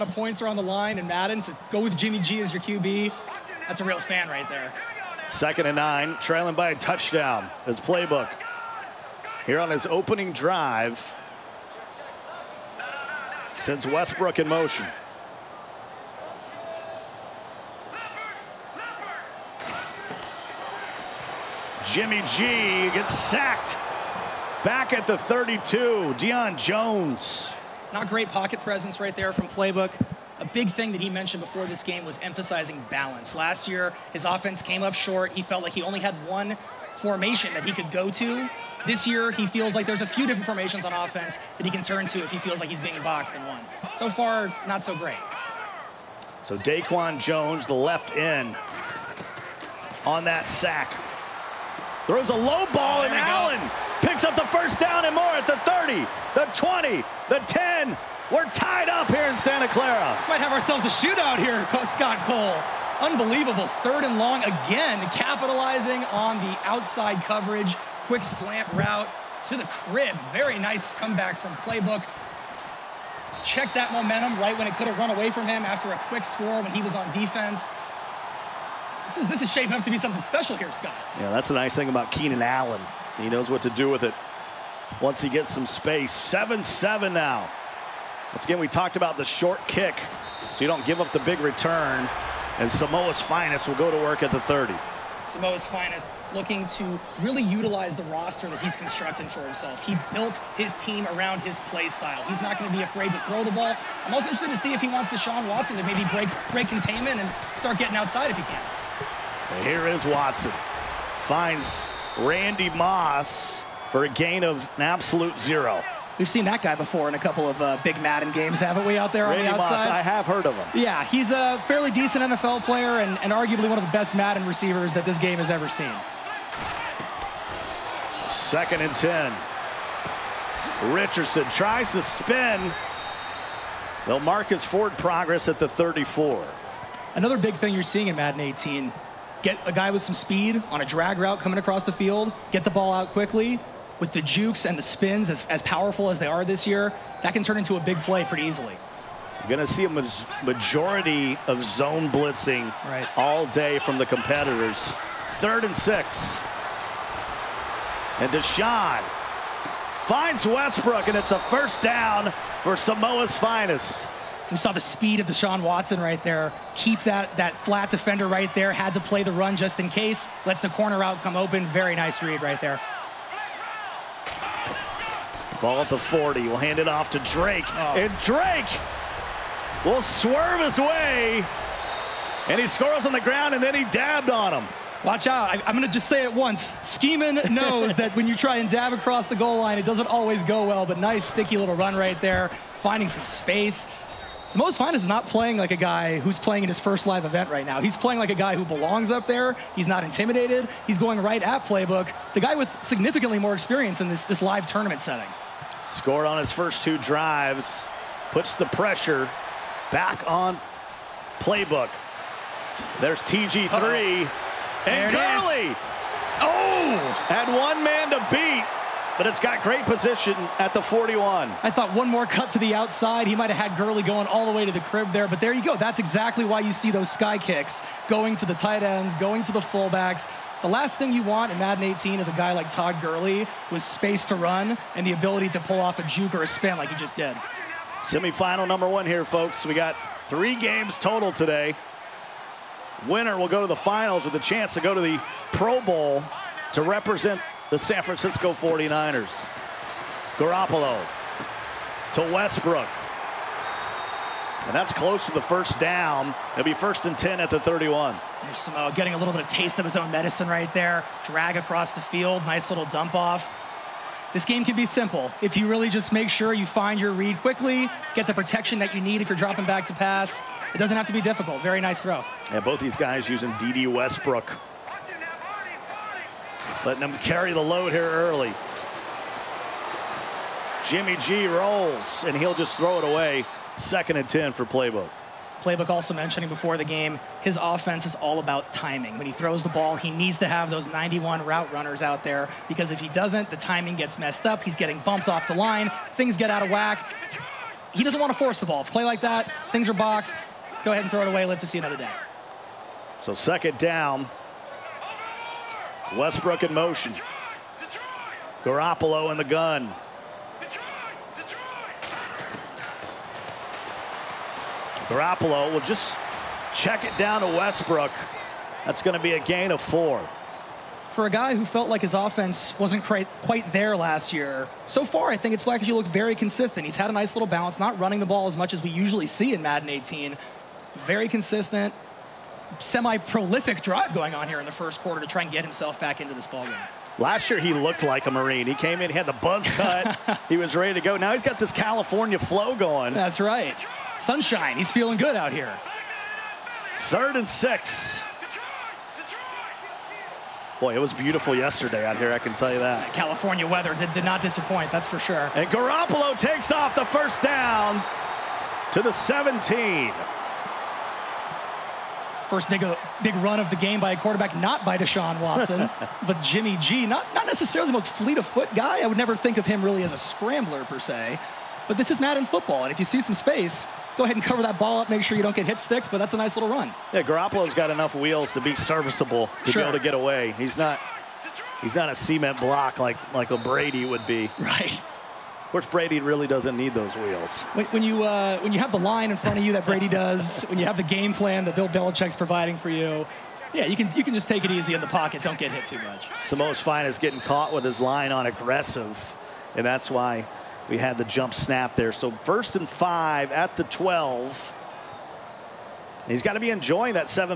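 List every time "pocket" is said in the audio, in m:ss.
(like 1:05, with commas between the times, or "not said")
0:28, 6:35.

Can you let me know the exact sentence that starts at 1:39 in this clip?
He built his team around his play style.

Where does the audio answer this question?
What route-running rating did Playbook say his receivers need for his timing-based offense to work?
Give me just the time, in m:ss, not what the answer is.
4:50.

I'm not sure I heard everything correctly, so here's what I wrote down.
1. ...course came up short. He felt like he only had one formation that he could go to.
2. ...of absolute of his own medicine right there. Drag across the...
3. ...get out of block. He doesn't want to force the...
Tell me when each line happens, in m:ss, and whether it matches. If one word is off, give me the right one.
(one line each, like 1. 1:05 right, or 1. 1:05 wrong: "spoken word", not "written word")
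1. 0:34 wrong: "offense", not "course"
2. 4:19 wrong: "taste", not "absolute"
3. 4:56 wrong: "whack", not "block".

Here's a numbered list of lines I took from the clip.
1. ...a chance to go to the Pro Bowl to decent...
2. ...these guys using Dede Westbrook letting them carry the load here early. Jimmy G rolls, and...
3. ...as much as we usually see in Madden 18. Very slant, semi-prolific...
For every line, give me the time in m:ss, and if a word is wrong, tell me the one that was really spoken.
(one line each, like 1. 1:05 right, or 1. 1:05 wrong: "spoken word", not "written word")
1. 4:04 wrong: "represent", not "decent"
2. 4:32 right
3. 5:28 wrong: "consistent", not "slant".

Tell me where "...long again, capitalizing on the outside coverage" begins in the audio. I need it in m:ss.
1:04.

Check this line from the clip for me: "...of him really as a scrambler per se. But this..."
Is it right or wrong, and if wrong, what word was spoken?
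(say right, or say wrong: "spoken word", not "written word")
right.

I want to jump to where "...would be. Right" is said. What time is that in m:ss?
6:24.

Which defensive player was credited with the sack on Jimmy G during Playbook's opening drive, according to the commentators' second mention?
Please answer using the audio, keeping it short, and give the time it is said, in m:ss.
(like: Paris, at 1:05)
Daquan Jones, at 0:46.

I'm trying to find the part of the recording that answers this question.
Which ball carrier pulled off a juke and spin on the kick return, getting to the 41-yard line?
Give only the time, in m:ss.
3:52.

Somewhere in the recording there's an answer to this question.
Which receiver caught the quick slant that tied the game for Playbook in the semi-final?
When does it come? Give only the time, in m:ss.
1:22.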